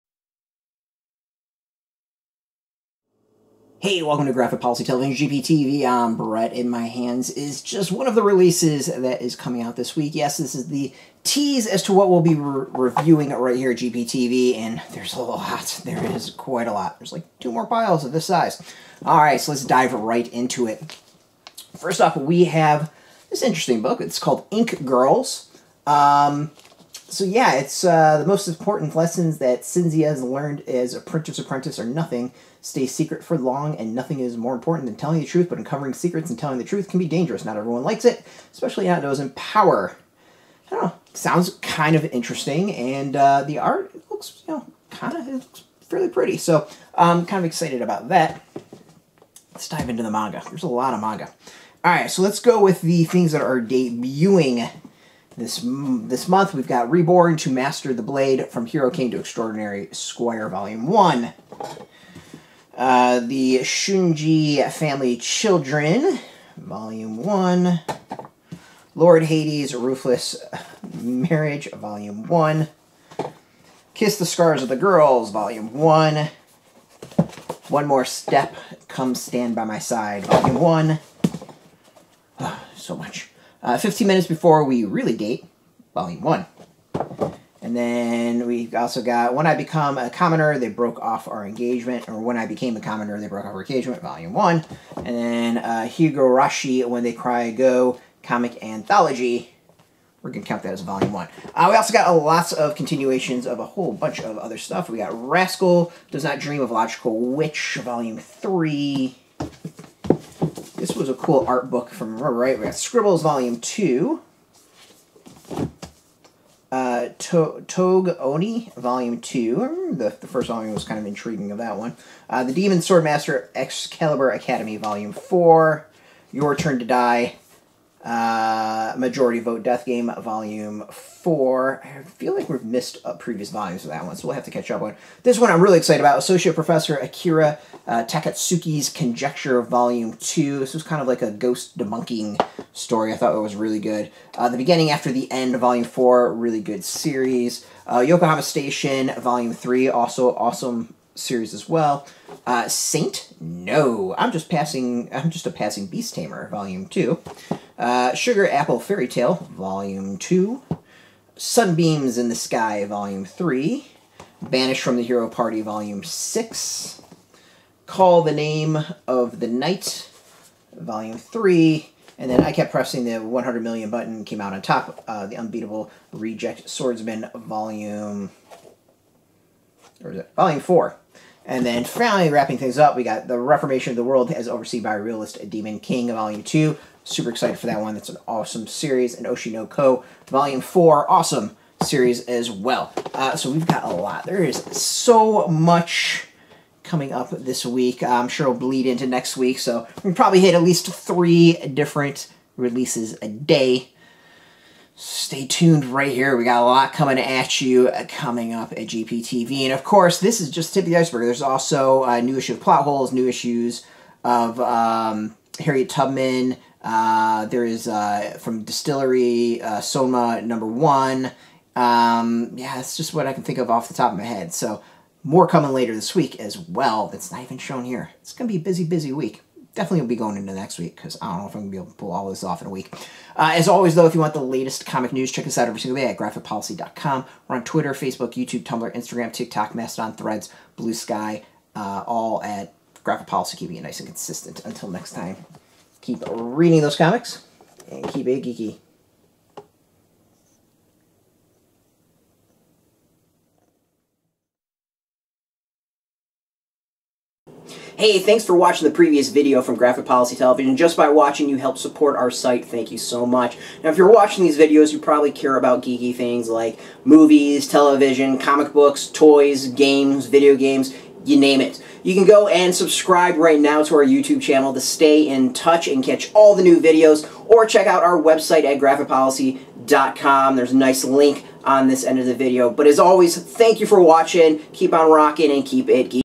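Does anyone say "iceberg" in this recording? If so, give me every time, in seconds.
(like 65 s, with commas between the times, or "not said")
210 s.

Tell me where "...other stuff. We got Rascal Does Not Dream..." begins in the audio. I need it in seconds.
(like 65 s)
104 s.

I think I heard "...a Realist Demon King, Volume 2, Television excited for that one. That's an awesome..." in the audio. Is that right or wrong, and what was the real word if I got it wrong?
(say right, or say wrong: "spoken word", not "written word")
wrong: "Super", not "Television".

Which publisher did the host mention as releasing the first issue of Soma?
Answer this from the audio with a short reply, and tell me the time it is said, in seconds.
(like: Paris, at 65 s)
Distillery, at 218 s.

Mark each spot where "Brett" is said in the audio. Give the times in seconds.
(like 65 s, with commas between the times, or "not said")
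6 s.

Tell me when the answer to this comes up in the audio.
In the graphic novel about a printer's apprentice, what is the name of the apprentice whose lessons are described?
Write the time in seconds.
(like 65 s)
29 s.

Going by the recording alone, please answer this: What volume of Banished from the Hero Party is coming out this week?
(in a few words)
6.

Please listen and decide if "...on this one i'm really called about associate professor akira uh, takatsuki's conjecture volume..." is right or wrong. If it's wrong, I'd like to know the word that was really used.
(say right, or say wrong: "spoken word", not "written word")
wrong: "excited", not "called".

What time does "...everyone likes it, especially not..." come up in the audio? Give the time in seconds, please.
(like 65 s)
37 s.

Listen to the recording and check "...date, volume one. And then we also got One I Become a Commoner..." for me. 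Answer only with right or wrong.
wrong.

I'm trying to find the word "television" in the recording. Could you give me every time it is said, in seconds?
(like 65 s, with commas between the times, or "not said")
4 s, 260 s, 267 s.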